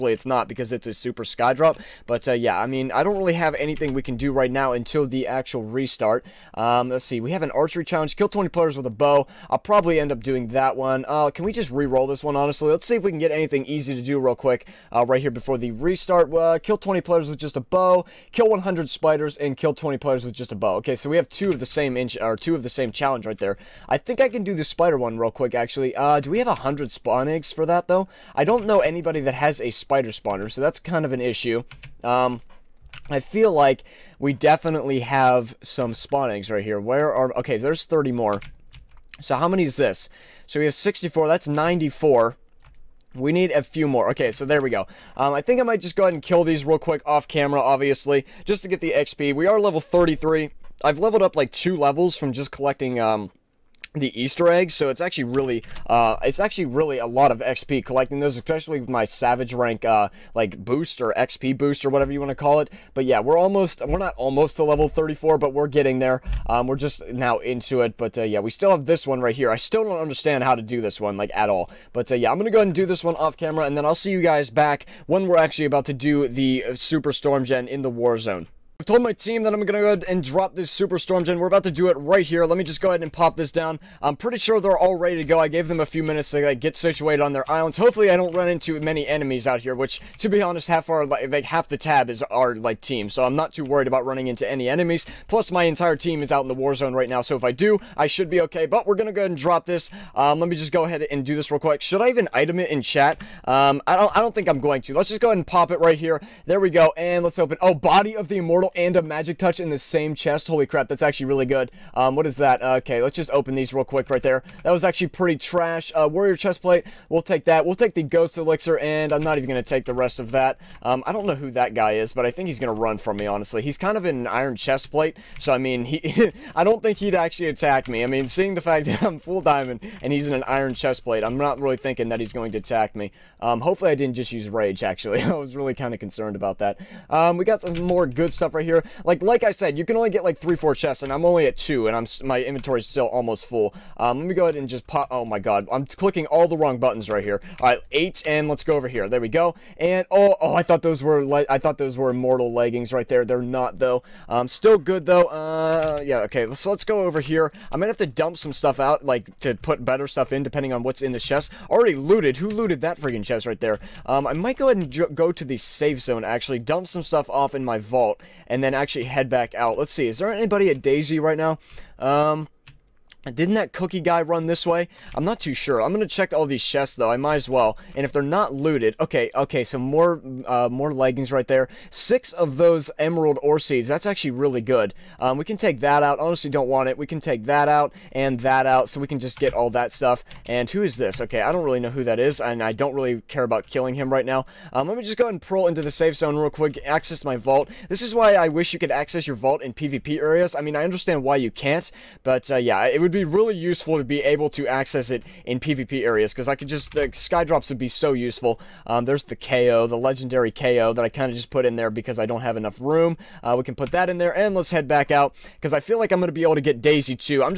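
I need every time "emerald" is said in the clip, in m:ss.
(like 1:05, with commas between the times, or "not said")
3:02.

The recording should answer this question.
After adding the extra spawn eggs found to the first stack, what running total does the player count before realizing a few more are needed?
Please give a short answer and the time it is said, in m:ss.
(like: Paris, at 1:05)
94, at 0:41.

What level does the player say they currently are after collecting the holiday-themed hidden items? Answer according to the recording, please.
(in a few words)
33.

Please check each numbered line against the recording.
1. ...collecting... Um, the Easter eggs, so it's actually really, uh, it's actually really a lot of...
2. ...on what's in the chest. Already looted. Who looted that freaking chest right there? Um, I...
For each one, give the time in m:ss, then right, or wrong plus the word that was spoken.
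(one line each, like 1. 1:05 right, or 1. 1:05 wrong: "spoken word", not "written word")
1. 0:52 right
2. 2:40 right.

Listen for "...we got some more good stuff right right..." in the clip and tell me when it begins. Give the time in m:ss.
2:17.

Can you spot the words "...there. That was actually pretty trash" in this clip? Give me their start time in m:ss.
1:54.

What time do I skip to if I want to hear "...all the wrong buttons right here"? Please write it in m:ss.
2:26.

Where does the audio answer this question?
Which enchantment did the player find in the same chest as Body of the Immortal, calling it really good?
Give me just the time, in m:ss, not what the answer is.
1:48.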